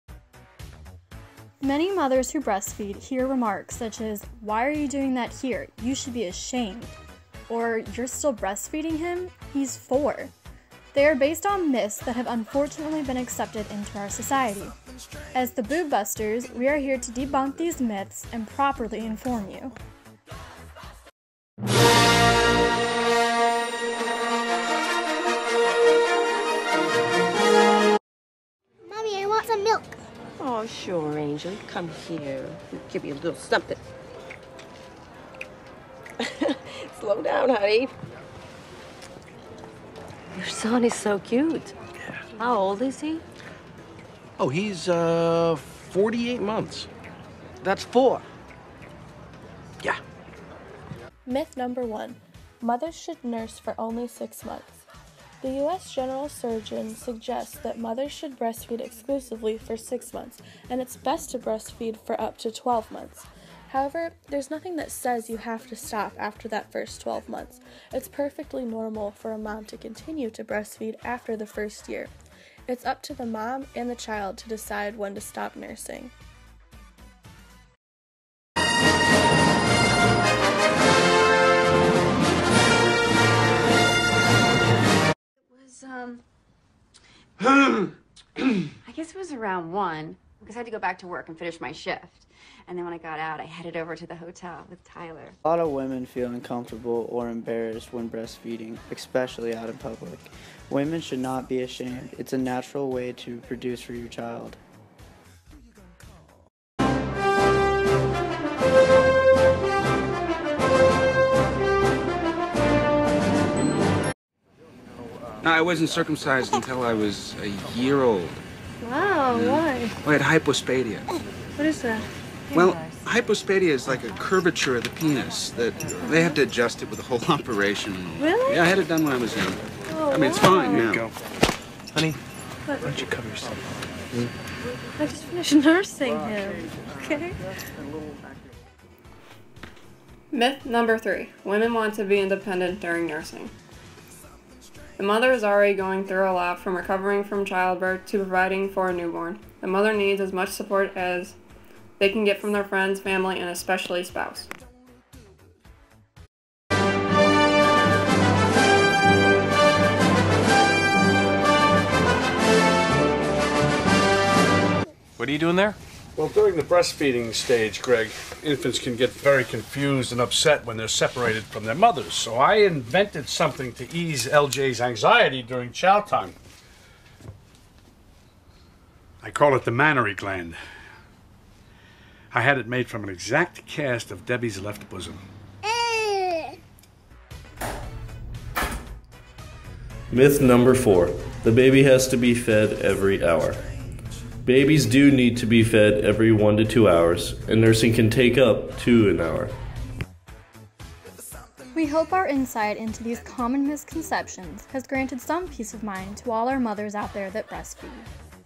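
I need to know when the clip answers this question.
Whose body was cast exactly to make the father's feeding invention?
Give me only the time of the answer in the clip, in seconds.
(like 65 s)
184 s.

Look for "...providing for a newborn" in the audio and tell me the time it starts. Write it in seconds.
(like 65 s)
148 s.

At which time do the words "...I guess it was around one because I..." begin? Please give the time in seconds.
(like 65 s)
88 s.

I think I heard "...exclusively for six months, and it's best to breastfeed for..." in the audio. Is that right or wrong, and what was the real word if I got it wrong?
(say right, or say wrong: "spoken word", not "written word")
right.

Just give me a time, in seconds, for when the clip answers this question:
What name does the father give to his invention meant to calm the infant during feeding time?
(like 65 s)
179 s.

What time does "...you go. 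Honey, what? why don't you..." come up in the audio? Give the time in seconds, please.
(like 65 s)
130 s.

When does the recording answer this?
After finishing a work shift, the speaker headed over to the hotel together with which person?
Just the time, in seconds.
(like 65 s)
94 s.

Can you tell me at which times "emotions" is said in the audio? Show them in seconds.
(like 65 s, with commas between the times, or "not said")
not said.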